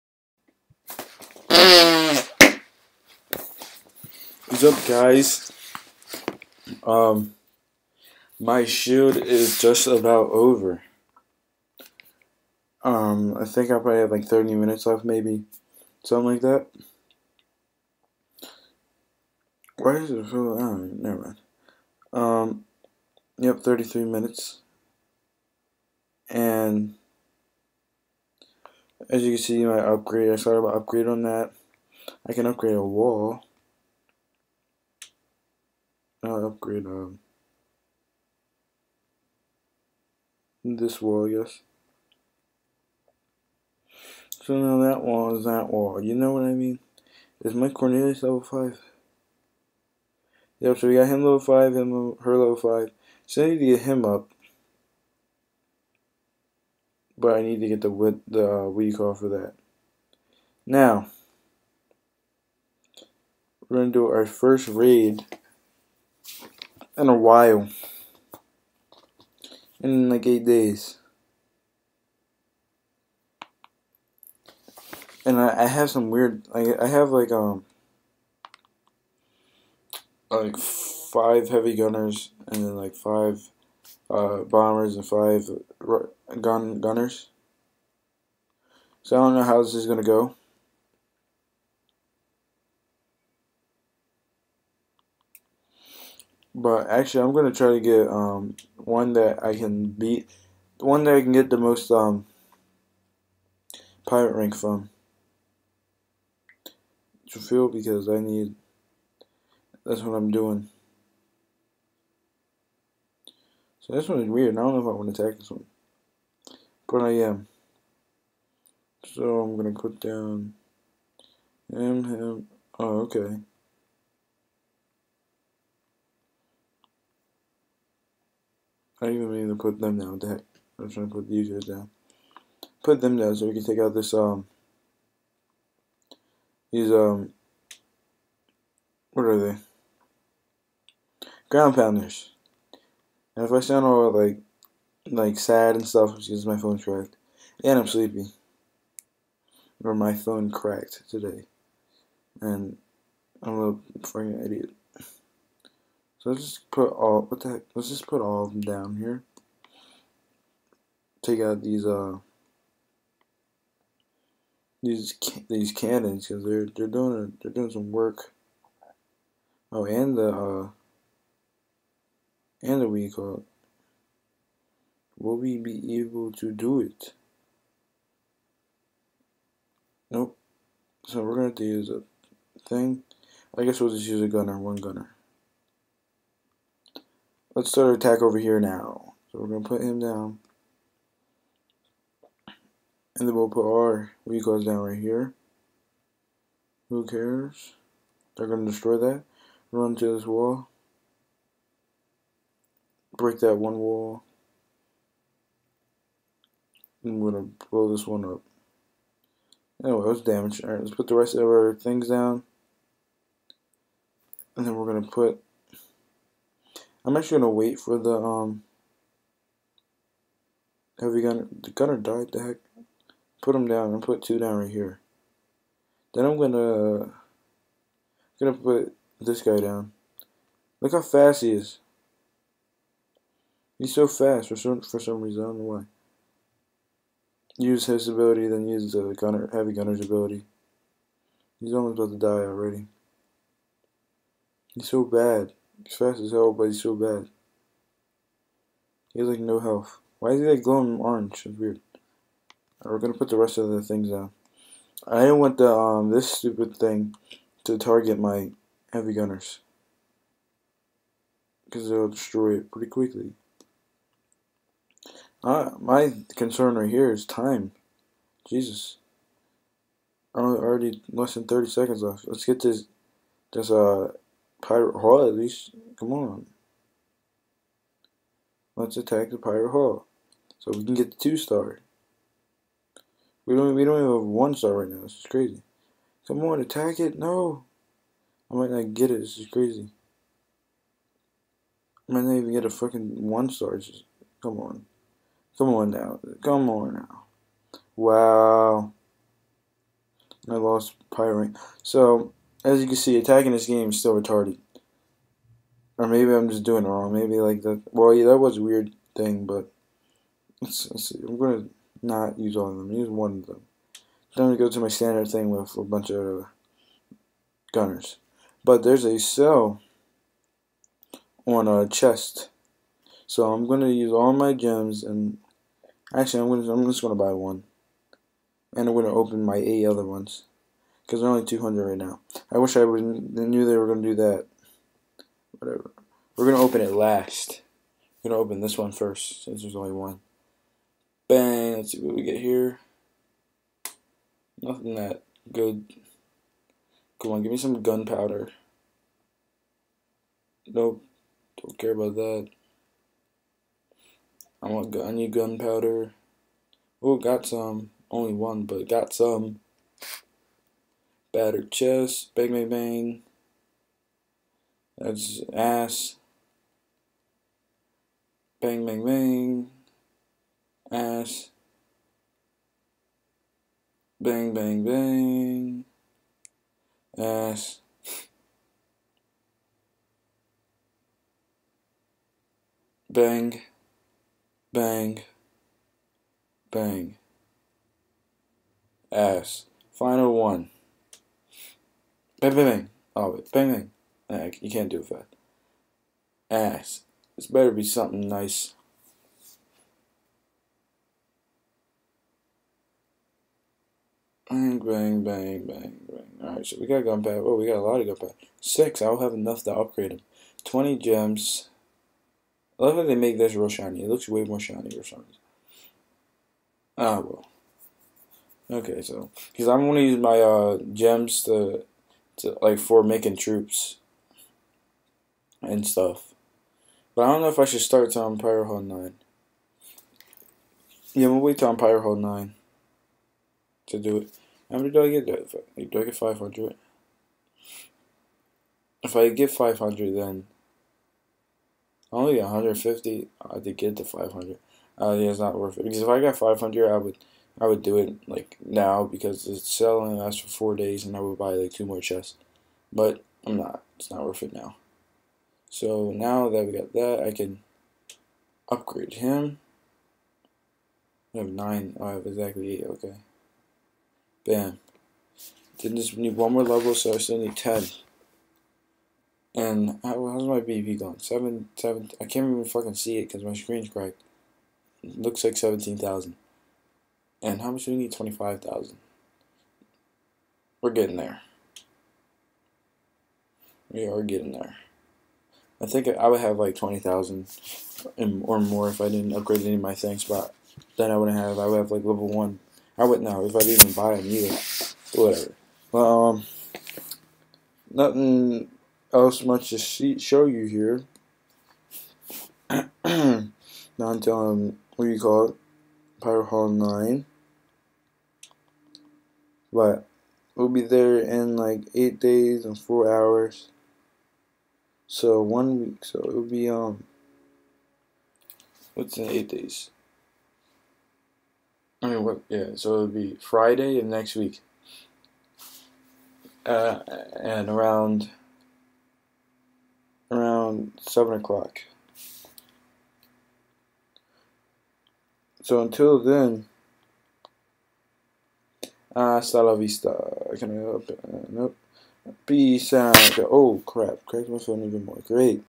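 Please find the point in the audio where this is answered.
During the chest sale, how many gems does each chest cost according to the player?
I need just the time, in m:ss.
5:31.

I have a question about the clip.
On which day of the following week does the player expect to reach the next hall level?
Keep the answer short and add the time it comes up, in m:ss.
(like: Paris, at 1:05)
Friday, at 8:43.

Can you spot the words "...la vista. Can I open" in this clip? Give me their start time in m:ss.
8:59.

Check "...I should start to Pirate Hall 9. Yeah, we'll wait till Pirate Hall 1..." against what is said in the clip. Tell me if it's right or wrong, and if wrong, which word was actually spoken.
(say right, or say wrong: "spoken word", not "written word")
wrong: "9", not "1".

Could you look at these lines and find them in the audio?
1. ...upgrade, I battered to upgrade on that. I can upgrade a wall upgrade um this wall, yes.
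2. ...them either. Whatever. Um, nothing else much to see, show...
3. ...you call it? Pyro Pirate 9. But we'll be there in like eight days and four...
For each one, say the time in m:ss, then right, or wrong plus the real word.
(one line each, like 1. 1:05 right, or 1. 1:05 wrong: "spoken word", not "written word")
1. 0:29 wrong: "started", not "battered"
2. 8:14 right
3. 8:25 wrong: "Hall", not "Pirate".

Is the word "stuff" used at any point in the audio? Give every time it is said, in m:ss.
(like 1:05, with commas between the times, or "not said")
2:25, 7:05.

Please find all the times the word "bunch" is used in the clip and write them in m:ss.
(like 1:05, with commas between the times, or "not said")
5:15.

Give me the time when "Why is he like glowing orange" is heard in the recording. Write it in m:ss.
4:10.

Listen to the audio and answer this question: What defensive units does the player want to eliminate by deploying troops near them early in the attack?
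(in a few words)
Ground pounders.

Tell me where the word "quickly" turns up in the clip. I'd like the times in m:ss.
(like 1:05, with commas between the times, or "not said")
4:22.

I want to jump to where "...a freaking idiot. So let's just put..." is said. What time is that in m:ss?
2:33.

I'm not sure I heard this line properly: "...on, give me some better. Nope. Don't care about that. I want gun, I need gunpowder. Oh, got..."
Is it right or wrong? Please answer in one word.
wrong.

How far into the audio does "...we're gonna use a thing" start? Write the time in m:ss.
3:01.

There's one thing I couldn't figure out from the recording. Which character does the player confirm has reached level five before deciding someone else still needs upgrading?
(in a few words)
Mike Cornelius.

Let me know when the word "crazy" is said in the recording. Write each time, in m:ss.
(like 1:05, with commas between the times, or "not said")
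4:45, 4:49.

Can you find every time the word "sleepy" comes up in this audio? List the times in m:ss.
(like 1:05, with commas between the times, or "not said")
2:27.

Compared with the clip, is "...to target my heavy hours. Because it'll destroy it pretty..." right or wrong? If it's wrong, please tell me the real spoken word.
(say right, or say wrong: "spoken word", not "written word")
wrong: "gunners", not "hours".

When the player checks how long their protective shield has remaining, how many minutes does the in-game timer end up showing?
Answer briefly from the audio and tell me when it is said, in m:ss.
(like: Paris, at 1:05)
33, at 0:23.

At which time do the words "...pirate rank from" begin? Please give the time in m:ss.
1:44.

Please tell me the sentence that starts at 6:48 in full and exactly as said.
Six, I'll have enough to upgrade them.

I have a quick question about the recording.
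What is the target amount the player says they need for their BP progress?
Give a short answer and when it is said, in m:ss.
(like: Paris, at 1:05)
25,000, at 7:58.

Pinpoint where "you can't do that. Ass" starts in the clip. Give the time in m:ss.
6:34.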